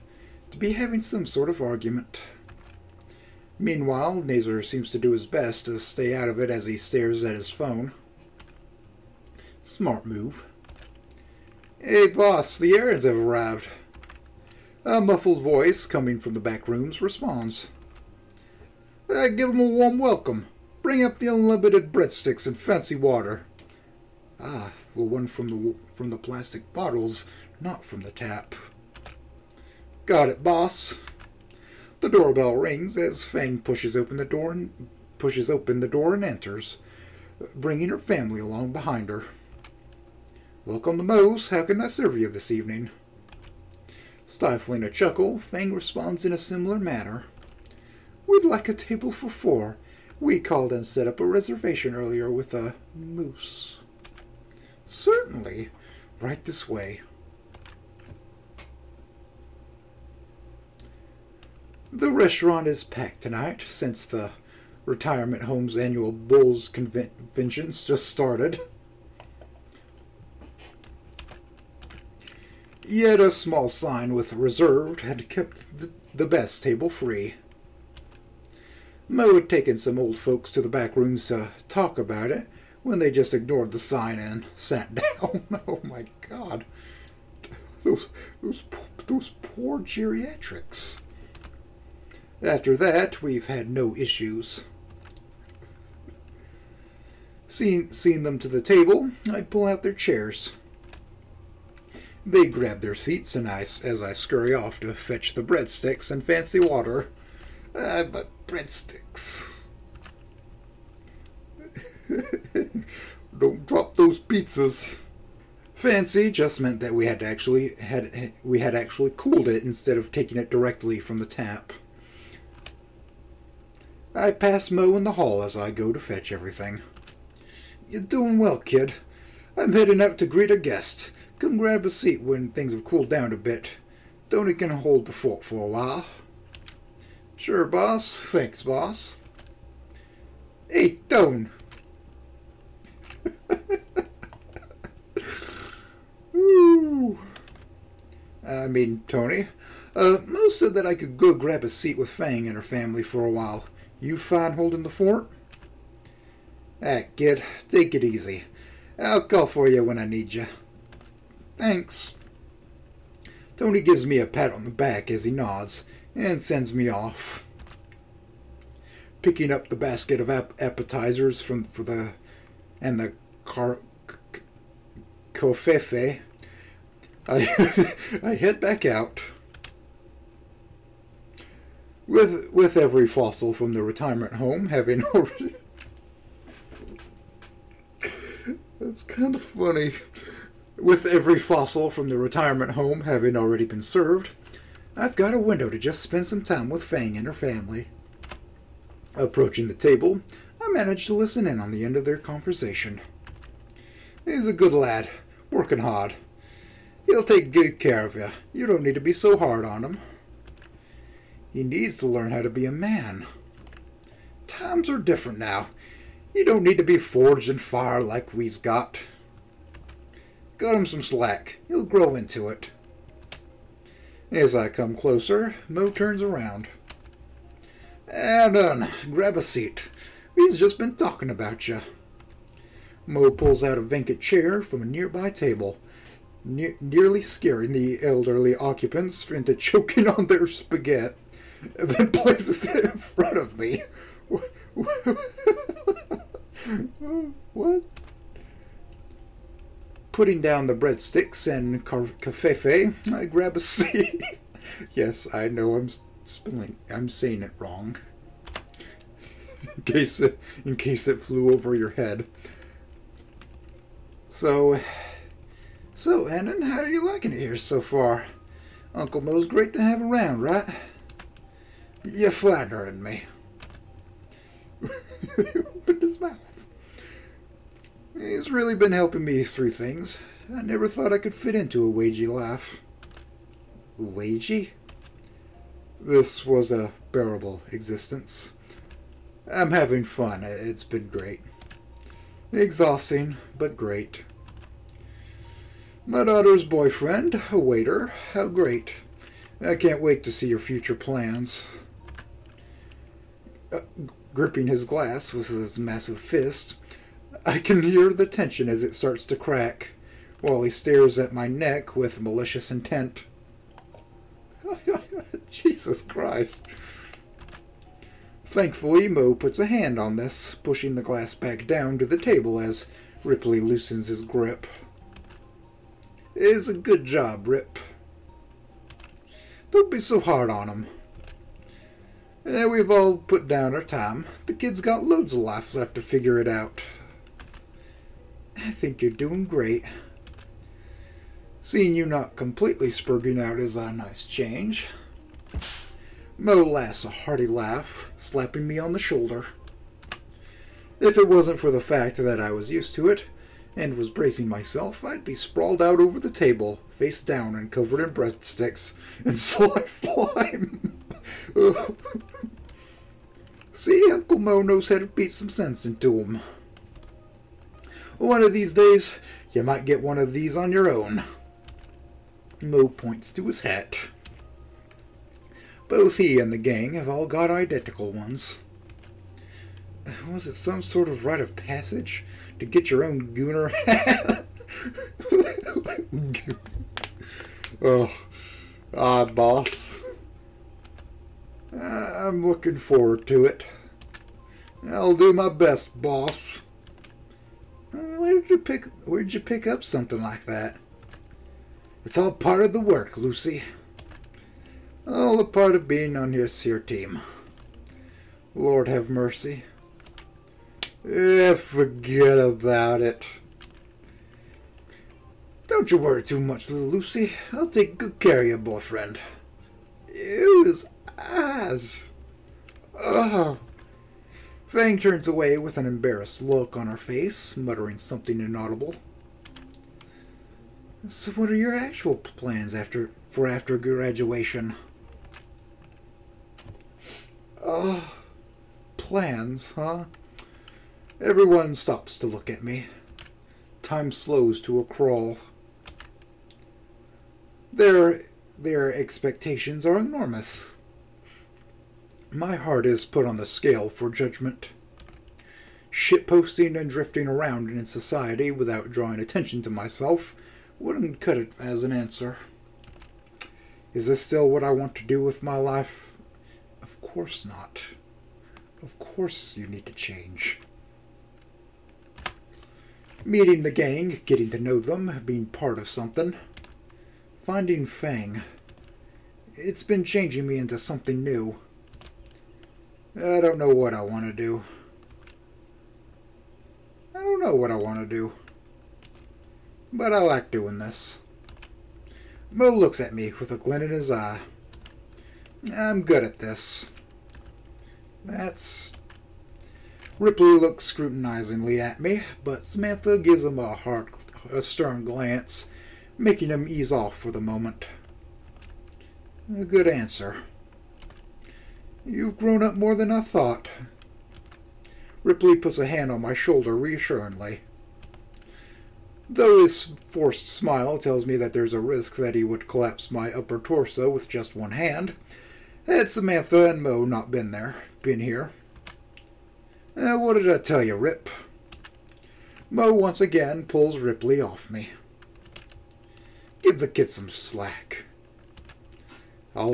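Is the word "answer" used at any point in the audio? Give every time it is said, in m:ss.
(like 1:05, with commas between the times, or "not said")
7:41, 8:29.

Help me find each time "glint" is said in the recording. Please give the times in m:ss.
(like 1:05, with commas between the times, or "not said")
8:13.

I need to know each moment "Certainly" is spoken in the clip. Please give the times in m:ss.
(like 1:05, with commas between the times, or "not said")
0:54.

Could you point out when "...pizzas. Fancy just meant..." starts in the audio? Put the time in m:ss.
1:54.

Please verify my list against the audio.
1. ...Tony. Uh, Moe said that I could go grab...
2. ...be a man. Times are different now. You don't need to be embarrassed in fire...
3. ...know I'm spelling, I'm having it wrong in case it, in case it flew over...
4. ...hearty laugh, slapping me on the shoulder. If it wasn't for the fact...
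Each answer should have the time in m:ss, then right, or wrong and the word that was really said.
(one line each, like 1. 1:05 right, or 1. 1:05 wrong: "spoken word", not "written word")
1. 2:29 right
2. 3:32 wrong: "forged", not "embarrassed"
3. 4:15 wrong: "saying", not "having"
4. 5:47 right.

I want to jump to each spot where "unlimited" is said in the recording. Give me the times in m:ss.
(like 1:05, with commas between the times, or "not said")
0:21.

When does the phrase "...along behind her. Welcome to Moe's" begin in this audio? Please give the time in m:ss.
0:38.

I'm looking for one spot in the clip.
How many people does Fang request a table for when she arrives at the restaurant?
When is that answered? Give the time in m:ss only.
0:49.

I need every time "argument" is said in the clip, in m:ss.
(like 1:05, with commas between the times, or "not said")
0:01.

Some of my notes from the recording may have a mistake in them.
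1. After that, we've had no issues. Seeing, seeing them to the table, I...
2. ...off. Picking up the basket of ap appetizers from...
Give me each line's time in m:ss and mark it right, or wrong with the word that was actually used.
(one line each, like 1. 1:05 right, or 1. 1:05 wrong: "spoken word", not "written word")
1. 1:32 right
2. 2:46 right.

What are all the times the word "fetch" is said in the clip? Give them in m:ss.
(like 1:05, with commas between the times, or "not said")
1:44, 2:05.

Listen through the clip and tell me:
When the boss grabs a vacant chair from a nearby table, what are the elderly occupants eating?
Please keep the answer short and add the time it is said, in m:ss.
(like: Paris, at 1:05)
Spaghetti, at 4:00.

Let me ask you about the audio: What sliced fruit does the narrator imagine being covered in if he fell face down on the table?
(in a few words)
Lime.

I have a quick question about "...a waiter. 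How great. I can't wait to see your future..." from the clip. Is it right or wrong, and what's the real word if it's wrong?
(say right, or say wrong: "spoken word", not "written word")
right.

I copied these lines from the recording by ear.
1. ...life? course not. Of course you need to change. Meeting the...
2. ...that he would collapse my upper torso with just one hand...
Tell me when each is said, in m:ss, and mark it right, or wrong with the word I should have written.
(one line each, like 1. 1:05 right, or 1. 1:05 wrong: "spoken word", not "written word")
1. 7:45 right
2. 8:42 right.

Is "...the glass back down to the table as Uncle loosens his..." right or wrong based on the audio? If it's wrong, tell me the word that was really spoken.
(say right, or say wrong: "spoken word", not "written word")
wrong: "Ripley", not "Uncle".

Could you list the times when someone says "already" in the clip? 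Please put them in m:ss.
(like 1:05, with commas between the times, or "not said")
3:05, 3:13.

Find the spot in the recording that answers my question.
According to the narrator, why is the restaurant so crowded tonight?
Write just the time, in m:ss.
1:06.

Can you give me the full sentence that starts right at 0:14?
A muffled voice coming from the back rooms responds.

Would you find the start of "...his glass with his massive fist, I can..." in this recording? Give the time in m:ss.
5:04.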